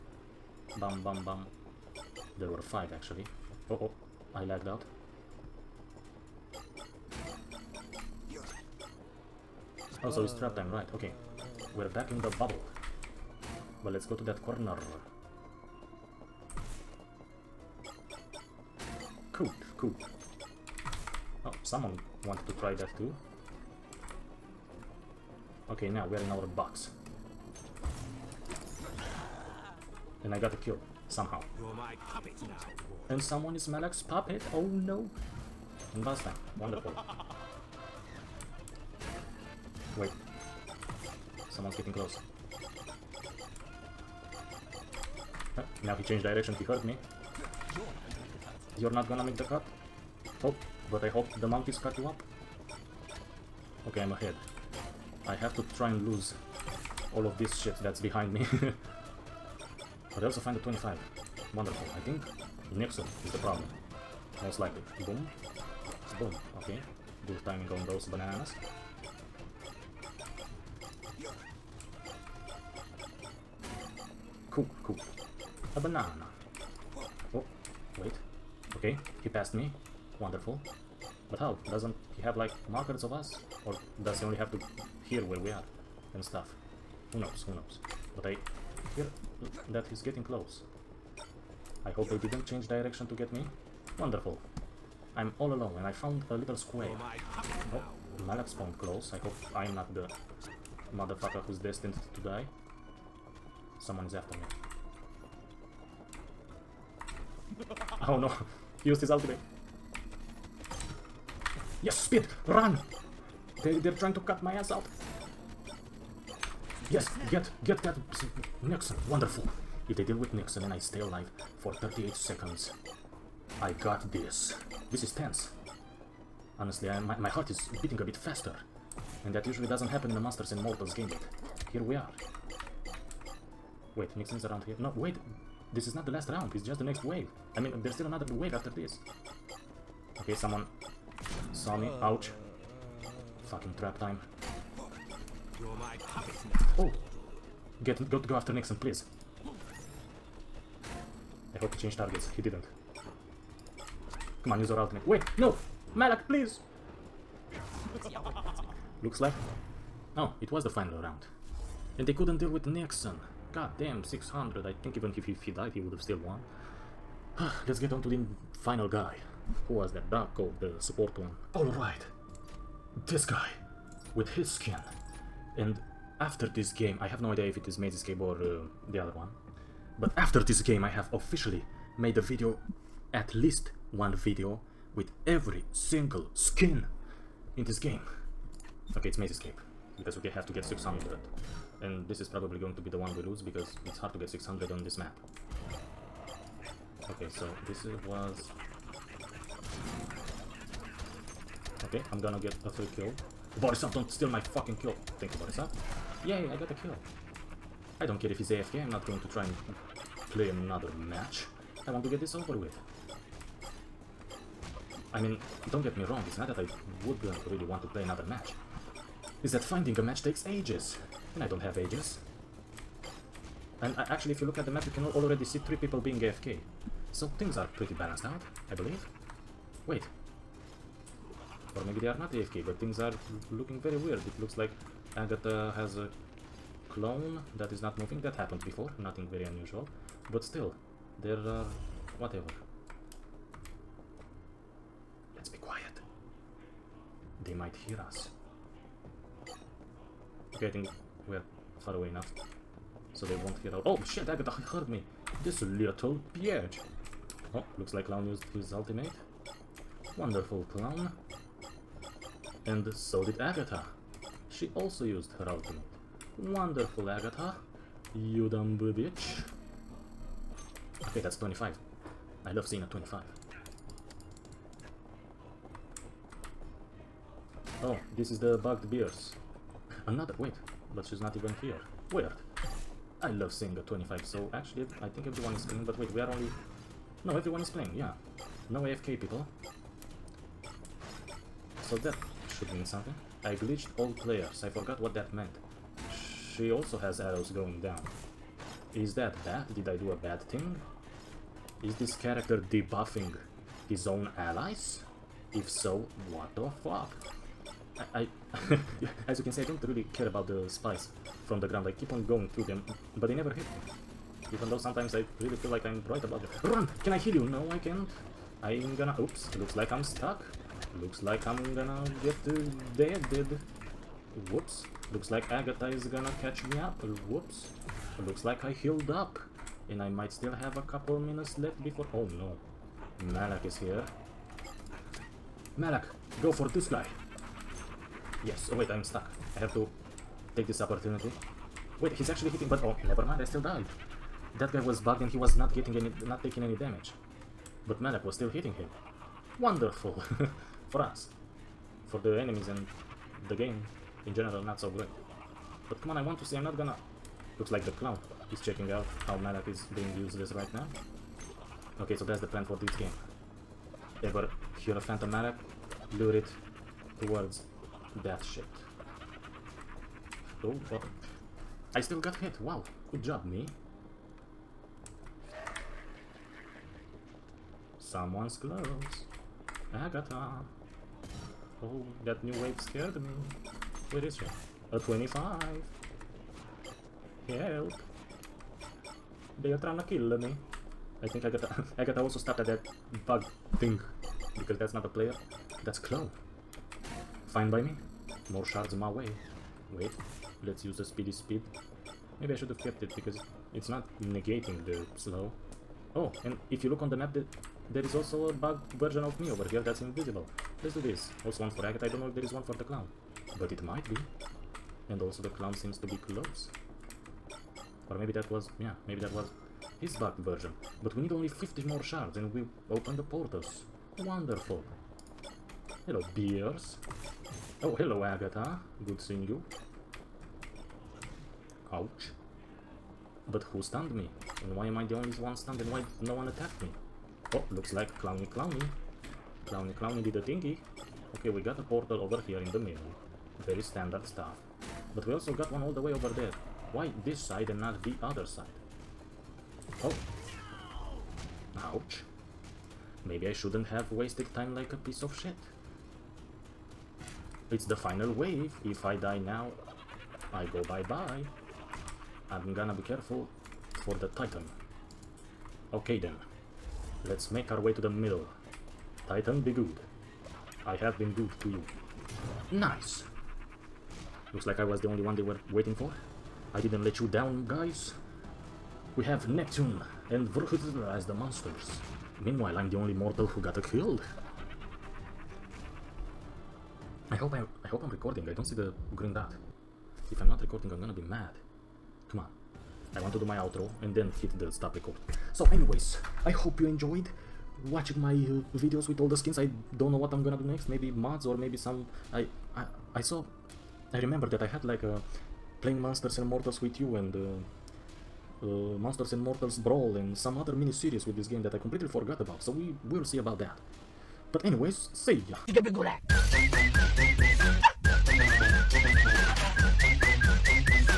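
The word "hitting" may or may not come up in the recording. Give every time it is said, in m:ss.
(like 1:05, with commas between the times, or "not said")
5:42, 5:48.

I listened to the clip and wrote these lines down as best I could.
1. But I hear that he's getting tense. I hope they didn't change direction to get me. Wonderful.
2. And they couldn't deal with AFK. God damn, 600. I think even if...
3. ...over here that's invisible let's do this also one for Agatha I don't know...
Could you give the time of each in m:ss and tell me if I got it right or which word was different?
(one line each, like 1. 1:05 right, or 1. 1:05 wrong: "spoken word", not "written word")
1. 1:28 wrong: "close", not "tense"
2. 2:41 wrong: "Nixon", not "AFK"
3. 6:49 right.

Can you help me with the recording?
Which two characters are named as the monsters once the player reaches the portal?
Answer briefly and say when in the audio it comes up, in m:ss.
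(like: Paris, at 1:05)
Neptune and Vrhutr, at 7:59.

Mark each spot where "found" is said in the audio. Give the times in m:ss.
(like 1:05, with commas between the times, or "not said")
1:35.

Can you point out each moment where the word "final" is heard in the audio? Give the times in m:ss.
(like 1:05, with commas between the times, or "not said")
2:40, 2:48, 7:37.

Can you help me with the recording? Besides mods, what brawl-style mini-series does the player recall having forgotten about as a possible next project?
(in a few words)
Monsters and Mortals Brawl.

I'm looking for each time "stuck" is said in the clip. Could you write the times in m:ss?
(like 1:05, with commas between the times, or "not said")
5:20, 5:39.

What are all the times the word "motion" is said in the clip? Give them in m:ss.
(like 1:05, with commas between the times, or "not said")
not said.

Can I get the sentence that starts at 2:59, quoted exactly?
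But after this game, I have officially made a video, at least one video, with every single skin in this game.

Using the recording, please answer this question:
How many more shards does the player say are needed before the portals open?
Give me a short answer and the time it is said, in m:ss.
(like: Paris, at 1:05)
50, at 7:01.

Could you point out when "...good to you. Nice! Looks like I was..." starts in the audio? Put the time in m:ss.
7:51.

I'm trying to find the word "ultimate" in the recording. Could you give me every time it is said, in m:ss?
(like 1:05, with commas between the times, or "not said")
1:49, 2:34, 4:18, 4:25.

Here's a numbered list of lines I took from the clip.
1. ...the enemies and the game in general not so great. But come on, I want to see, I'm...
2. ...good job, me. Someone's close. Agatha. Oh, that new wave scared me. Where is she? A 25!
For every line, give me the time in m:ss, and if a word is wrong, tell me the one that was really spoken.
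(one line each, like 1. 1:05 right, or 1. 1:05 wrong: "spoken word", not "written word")
1. 5:52 right
2. 6:13 right.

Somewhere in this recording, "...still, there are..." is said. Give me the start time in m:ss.
4:00.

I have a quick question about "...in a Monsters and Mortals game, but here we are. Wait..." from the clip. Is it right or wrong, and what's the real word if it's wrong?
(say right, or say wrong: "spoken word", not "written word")
right.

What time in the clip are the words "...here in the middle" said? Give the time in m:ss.
7:22.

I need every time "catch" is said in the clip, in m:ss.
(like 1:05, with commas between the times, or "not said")
5:26.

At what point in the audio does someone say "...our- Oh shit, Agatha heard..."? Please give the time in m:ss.
4:13.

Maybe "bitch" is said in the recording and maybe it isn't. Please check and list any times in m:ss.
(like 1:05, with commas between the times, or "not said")
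4:16, 4:28.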